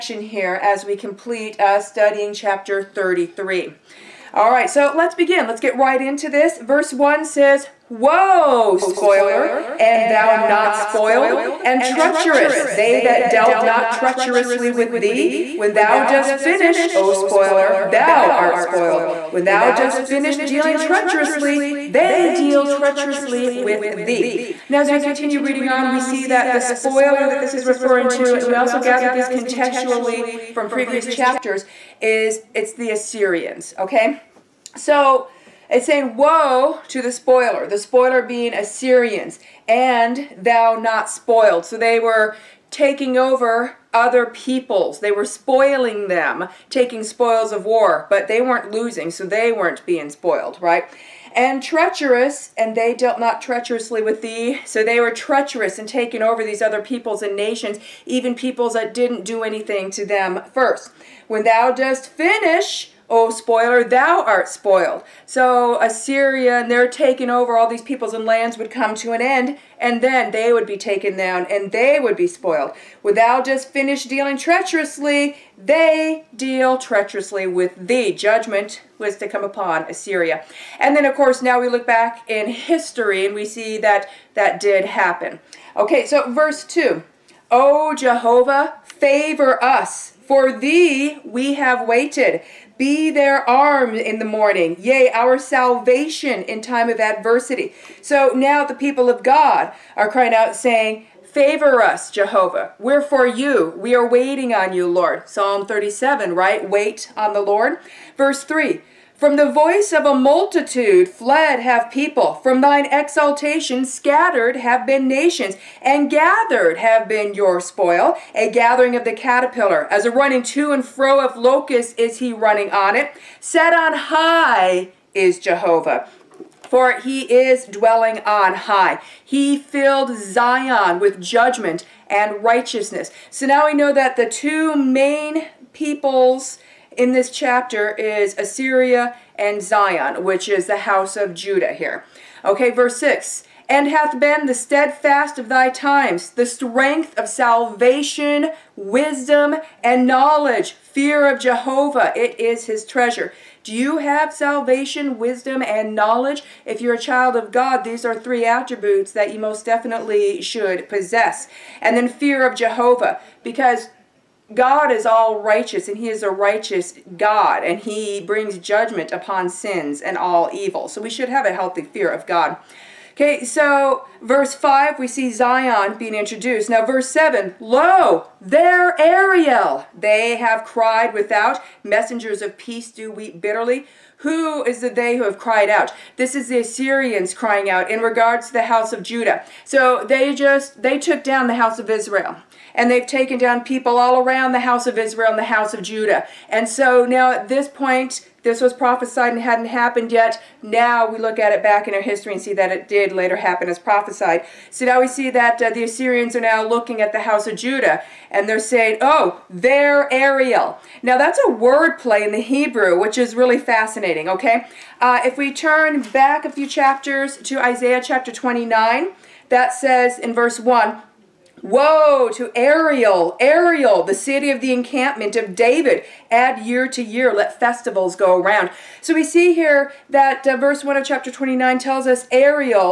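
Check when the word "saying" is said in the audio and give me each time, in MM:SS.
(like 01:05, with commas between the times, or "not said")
00:35, 01:40, 03:28.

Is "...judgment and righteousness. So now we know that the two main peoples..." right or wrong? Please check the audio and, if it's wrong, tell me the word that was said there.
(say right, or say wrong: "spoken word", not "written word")
right.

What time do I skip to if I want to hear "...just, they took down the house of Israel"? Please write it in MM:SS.
03:10.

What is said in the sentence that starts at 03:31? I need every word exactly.
Now that's a word play in the Hebrew, which is really fascinating okay?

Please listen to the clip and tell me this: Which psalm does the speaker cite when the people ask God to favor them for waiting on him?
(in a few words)
Psalm 37.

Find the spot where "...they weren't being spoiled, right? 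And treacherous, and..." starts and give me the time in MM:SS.
00:49.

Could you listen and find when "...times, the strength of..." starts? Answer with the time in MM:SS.
02:25.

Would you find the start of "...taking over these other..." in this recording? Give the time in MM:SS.
00:55.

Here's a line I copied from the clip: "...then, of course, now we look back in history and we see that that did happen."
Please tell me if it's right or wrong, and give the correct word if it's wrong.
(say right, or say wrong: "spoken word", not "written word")
right.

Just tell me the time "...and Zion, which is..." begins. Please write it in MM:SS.
02:19.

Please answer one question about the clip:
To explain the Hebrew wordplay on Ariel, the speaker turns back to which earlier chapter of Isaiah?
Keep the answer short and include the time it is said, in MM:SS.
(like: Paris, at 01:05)
Chapter 29, at 03:37.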